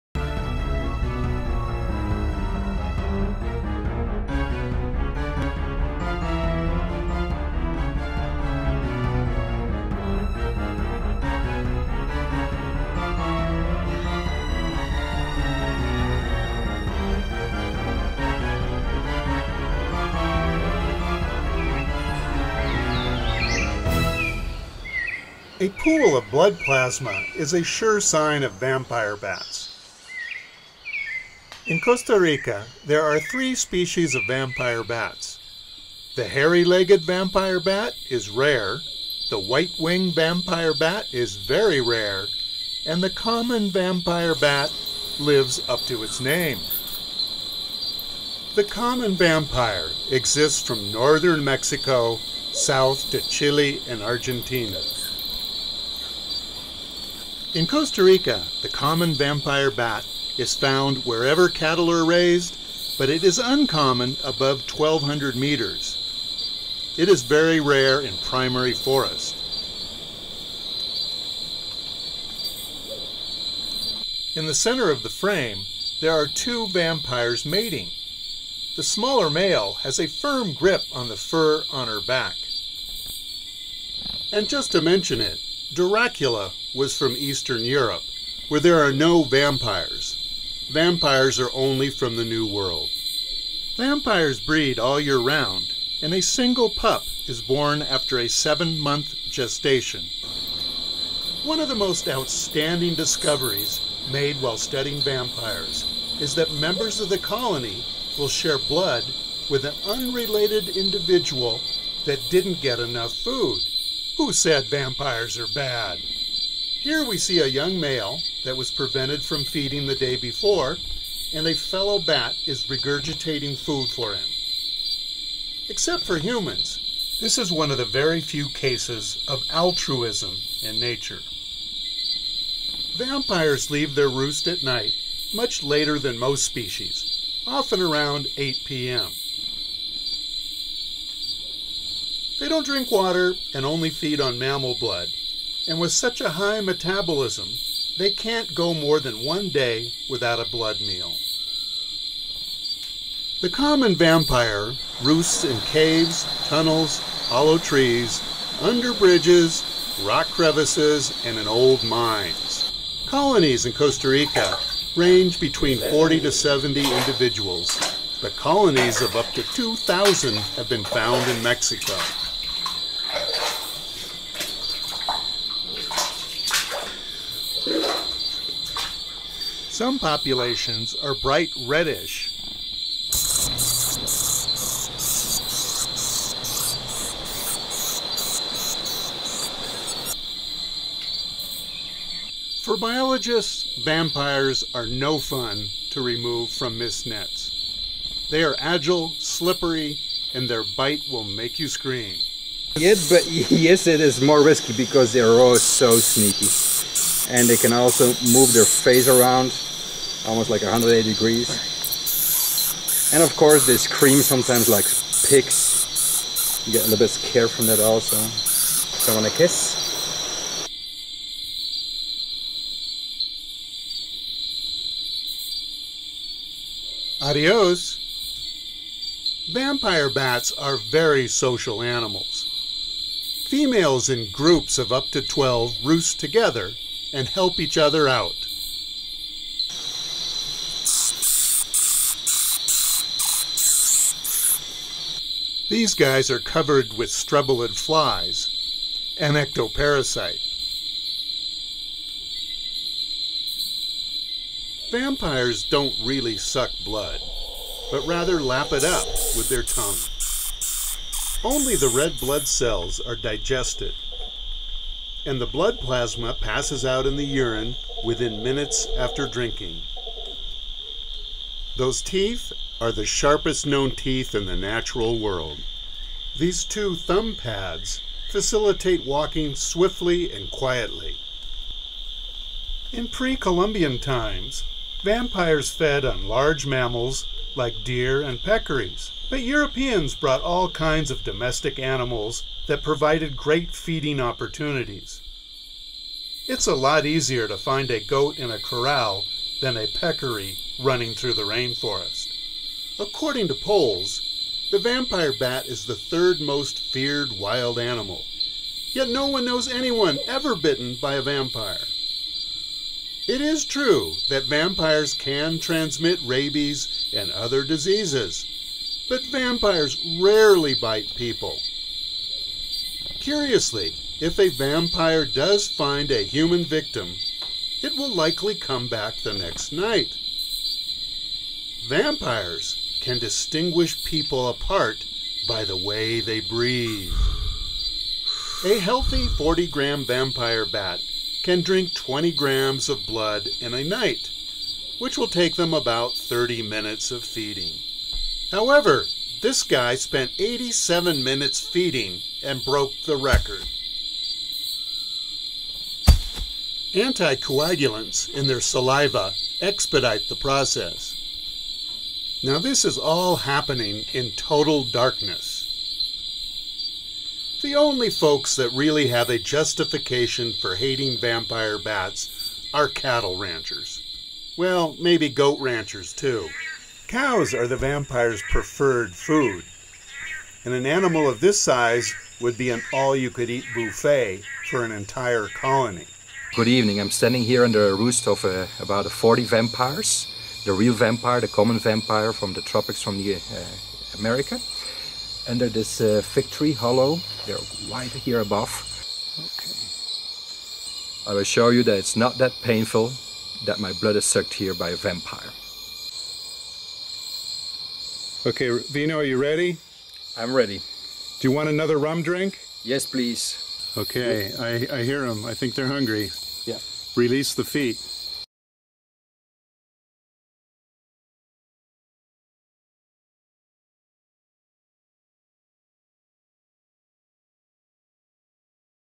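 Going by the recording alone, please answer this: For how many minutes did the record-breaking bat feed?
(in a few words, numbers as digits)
87 minutes.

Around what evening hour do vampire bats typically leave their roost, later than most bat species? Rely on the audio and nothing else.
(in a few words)
8 p.m.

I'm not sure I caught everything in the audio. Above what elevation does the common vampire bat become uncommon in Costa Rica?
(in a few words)
1200 meters.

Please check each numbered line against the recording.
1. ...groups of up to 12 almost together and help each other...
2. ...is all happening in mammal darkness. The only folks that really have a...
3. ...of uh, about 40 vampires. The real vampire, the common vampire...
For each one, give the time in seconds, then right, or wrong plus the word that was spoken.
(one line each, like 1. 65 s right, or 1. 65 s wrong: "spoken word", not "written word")
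1. 234 s wrong: "roost", not "almost"
2. 362 s wrong: "total", not "mammal"
3. 388 s right.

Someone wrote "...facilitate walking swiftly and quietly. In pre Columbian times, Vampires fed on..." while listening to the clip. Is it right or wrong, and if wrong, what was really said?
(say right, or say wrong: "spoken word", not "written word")
right.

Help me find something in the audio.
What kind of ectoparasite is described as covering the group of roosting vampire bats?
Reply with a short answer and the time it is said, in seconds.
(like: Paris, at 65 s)
Streblid flies, at 247 s.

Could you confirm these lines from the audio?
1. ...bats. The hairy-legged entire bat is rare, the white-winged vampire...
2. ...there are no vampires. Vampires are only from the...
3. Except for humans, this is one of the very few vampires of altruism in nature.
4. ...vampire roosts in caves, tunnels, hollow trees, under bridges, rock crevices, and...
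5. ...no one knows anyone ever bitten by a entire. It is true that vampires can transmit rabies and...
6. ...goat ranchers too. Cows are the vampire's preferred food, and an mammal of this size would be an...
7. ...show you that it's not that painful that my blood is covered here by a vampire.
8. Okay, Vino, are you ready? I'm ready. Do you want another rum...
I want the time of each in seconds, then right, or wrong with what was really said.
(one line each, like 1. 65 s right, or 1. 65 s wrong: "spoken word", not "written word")
1. 34 s wrong: "vampire", not "entire"
2. 88 s right
3. 125 s wrong: "cases", not "vampires"
4. 153 s right
5. 309 s wrong: "vampire", not "entire"
6. 375 s wrong: "animal", not "mammal"
7. 401 s wrong: "sucked", not "covered"
8. 408 s right.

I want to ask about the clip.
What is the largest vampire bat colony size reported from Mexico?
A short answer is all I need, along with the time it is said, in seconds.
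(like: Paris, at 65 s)
2,000, at 169 s.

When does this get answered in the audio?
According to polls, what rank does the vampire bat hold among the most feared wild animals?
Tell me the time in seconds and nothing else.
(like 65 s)
305 s.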